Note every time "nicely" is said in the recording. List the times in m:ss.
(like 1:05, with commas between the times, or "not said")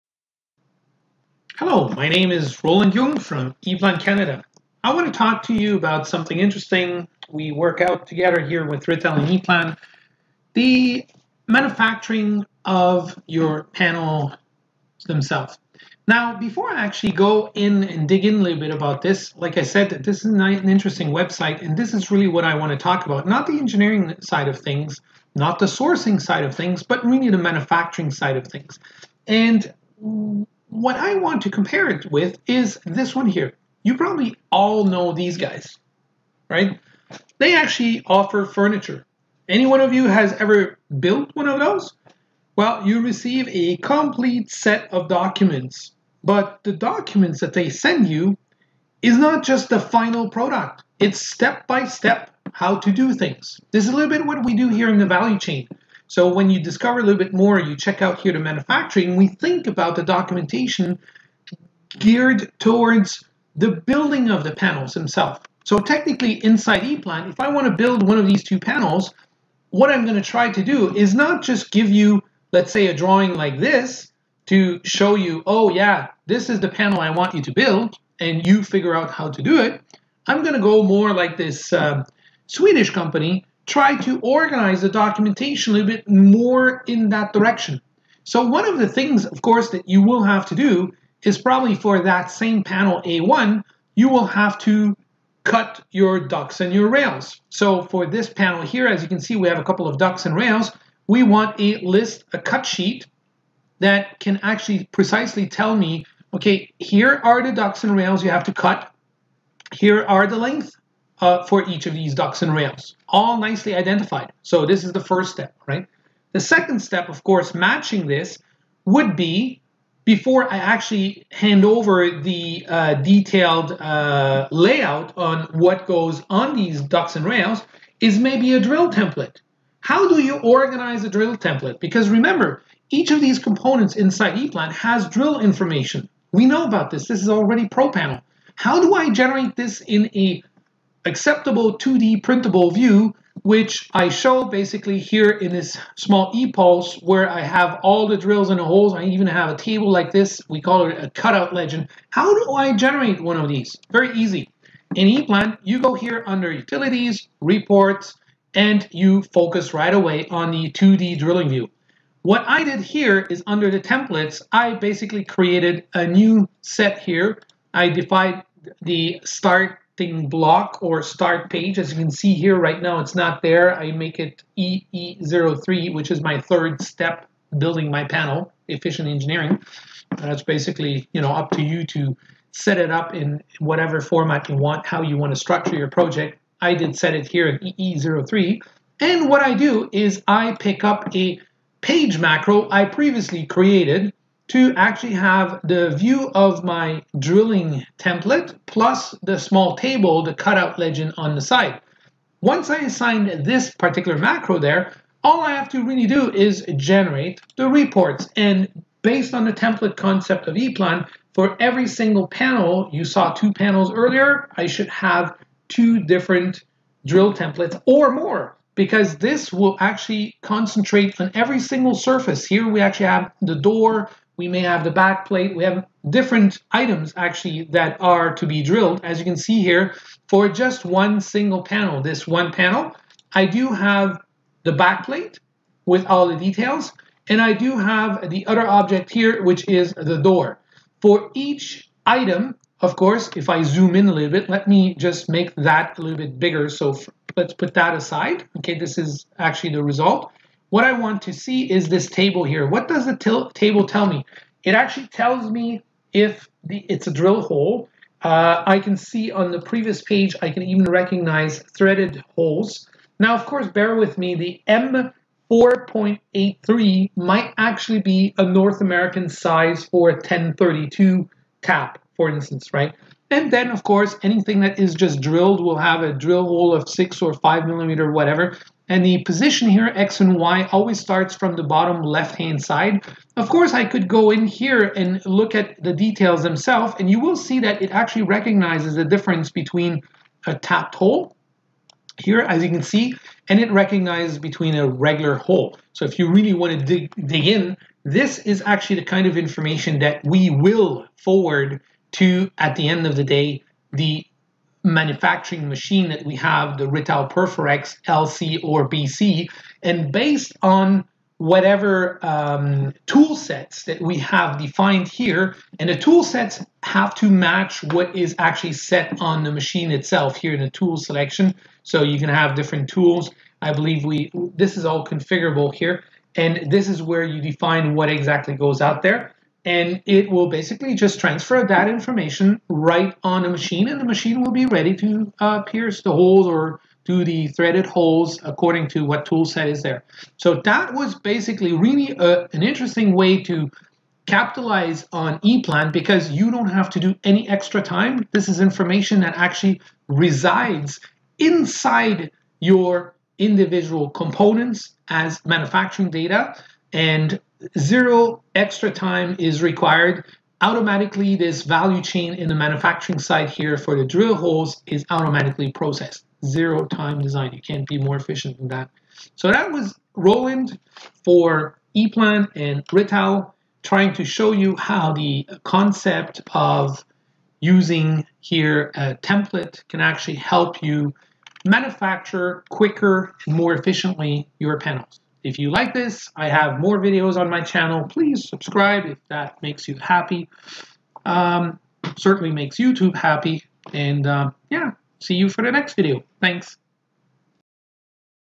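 1:53.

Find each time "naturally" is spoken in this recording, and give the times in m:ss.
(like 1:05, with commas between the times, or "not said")
not said.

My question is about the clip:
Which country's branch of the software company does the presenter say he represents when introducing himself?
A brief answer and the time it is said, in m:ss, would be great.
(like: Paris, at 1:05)
Canada, at 0:03.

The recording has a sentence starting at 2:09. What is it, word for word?
How do you organize a drill template?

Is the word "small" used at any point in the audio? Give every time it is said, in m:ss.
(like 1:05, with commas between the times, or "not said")
2:25, 3:19.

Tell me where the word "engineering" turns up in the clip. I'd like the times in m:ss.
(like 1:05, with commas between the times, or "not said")
0:23, 2:59.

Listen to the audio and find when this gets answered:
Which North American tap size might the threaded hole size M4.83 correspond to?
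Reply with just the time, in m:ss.
4:30.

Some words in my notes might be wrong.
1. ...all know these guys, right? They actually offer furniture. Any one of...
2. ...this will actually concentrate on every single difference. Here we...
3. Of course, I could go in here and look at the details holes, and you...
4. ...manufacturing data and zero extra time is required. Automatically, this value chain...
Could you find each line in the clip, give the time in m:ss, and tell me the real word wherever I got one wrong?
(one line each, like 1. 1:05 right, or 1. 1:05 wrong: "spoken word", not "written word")
1. 0:34 right
2. 3:39 wrong: "surface", not "difference"
3. 4:43 wrong: "themselves", not "holes"
4. 5:55 right.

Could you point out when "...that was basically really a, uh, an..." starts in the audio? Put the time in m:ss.
5:40.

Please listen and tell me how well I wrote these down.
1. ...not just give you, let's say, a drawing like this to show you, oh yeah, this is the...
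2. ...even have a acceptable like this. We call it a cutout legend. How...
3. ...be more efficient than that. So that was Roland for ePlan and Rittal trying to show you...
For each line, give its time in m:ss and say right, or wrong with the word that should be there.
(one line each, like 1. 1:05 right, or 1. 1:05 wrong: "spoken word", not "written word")
1. 1:11 right
2. 2:29 wrong: "table", not "acceptable"
3. 6:07 right.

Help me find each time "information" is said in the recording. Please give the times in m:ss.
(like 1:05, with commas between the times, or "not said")
2:15, 4:59, 5:31, 5:48.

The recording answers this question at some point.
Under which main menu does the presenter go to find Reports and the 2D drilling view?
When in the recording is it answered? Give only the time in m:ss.
2:36.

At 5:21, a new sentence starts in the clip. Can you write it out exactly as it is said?
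So you can have different tools.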